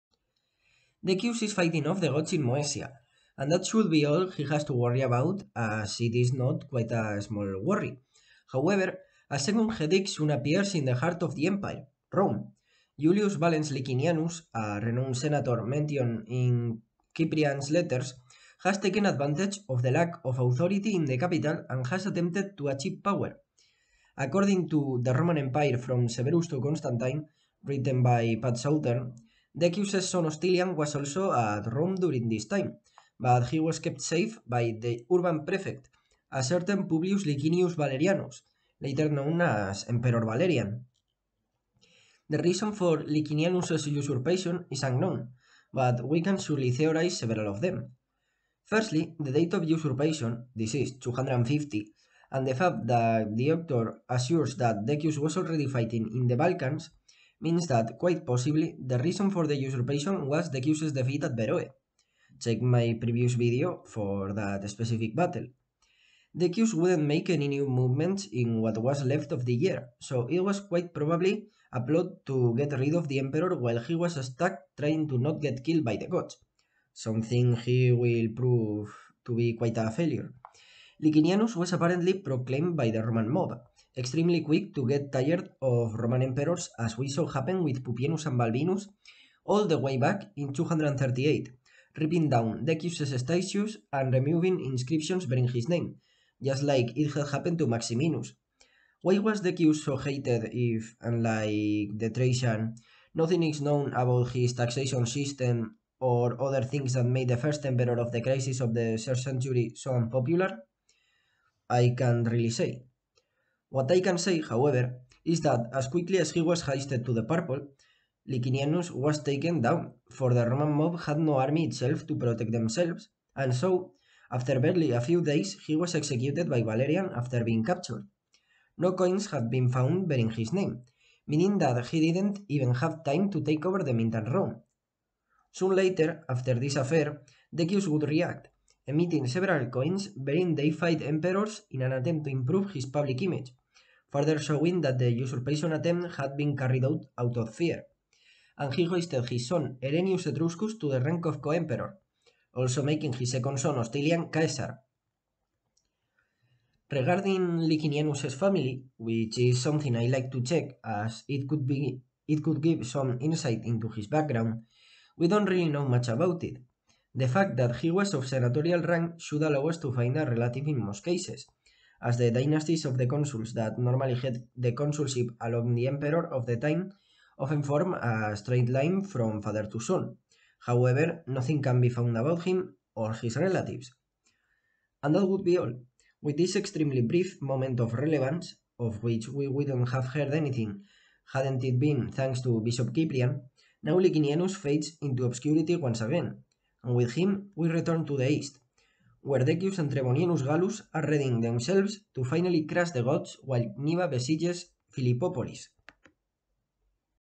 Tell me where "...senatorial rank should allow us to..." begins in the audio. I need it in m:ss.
2:48.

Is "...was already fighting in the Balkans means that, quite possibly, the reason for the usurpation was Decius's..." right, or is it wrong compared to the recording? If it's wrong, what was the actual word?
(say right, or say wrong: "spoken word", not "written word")
right.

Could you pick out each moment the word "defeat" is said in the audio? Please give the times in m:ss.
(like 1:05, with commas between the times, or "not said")
1:00.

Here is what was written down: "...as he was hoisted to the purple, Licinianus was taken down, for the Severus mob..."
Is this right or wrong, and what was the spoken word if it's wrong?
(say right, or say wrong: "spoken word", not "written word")
wrong: "Roman", not "Severus".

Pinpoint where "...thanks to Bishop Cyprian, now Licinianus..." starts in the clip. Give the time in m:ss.
3:12.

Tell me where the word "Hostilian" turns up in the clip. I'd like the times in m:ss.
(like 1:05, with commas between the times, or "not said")
0:30, 2:33.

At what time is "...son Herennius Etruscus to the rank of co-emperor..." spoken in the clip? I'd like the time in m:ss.
2:29.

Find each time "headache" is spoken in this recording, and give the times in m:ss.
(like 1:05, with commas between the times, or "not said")
0:09.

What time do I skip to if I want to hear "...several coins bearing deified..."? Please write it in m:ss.
2:19.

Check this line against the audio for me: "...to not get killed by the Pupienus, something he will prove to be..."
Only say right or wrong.
wrong.